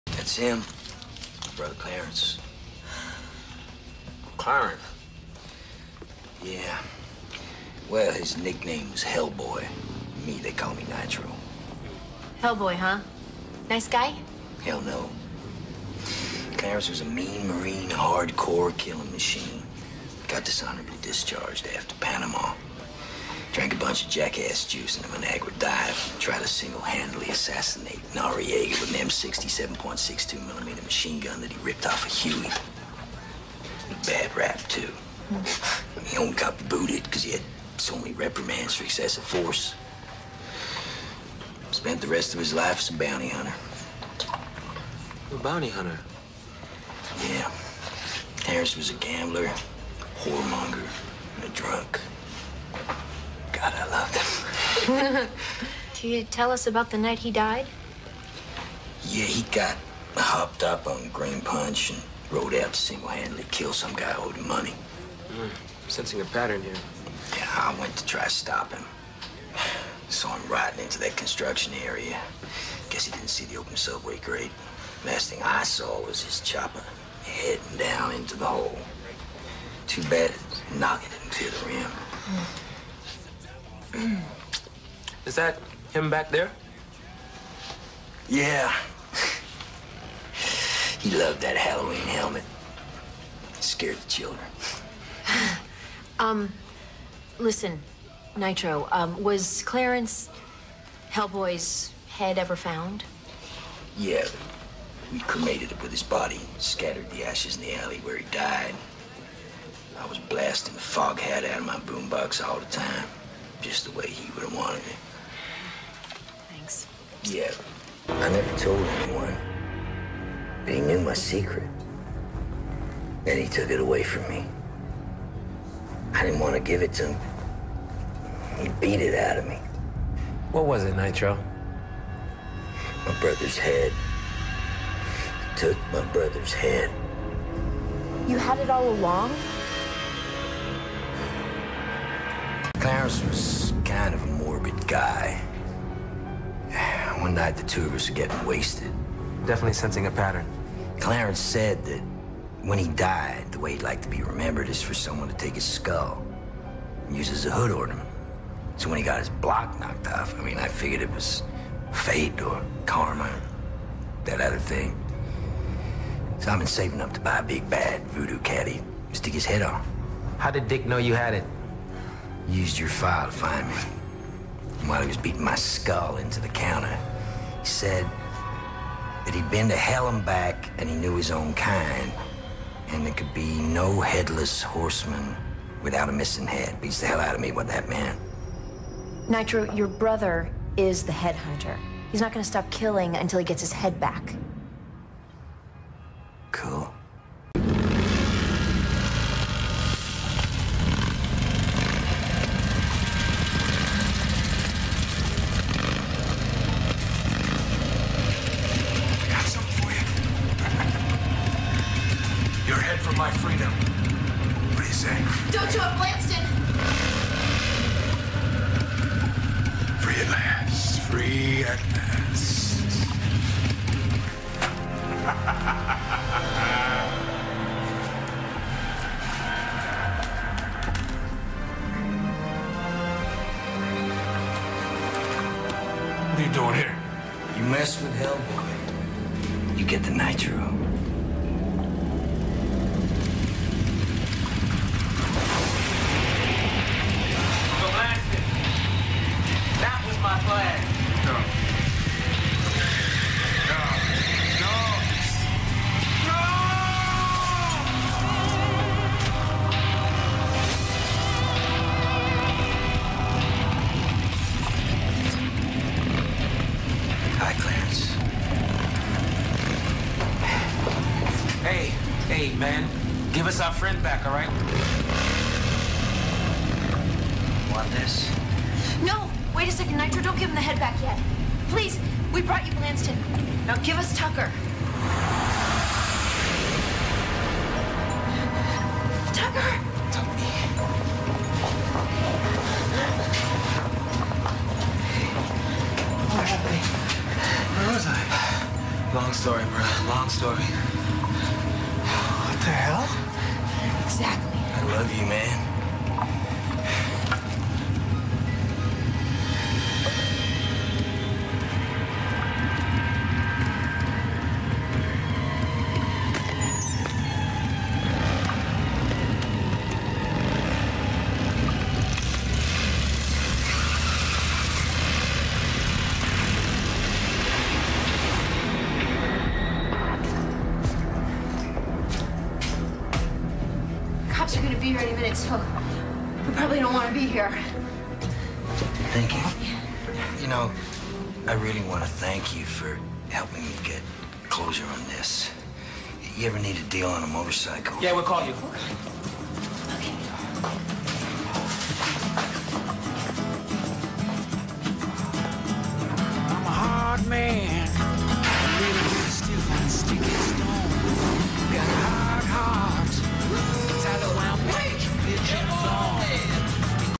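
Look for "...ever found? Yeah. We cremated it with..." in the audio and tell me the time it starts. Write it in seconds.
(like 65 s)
102 s.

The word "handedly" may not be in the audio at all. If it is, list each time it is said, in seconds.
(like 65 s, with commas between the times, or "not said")
26 s, 62 s.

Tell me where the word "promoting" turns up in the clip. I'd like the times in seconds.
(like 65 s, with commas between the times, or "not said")
not said.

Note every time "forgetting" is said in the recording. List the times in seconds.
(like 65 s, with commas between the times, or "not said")
not said.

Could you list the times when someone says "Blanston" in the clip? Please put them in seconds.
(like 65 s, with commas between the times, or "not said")
215 s, 282 s.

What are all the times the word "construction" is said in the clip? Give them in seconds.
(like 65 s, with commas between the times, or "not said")
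71 s.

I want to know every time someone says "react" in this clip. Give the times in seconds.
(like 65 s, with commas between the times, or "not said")
not said.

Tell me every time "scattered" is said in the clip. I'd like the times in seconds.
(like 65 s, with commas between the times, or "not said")
106 s.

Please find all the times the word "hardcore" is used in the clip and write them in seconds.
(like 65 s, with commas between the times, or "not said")
17 s.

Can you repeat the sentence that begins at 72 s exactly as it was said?
Guess he didn't see the open subway grate.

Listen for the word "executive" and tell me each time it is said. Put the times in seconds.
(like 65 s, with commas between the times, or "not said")
not said.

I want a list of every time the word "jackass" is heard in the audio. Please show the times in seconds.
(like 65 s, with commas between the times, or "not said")
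24 s.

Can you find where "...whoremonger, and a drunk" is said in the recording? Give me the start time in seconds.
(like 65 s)
50 s.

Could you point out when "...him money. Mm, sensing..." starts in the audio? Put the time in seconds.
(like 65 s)
64 s.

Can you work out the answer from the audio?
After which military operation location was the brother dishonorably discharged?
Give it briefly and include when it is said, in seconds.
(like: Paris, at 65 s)
Panama, at 21 s.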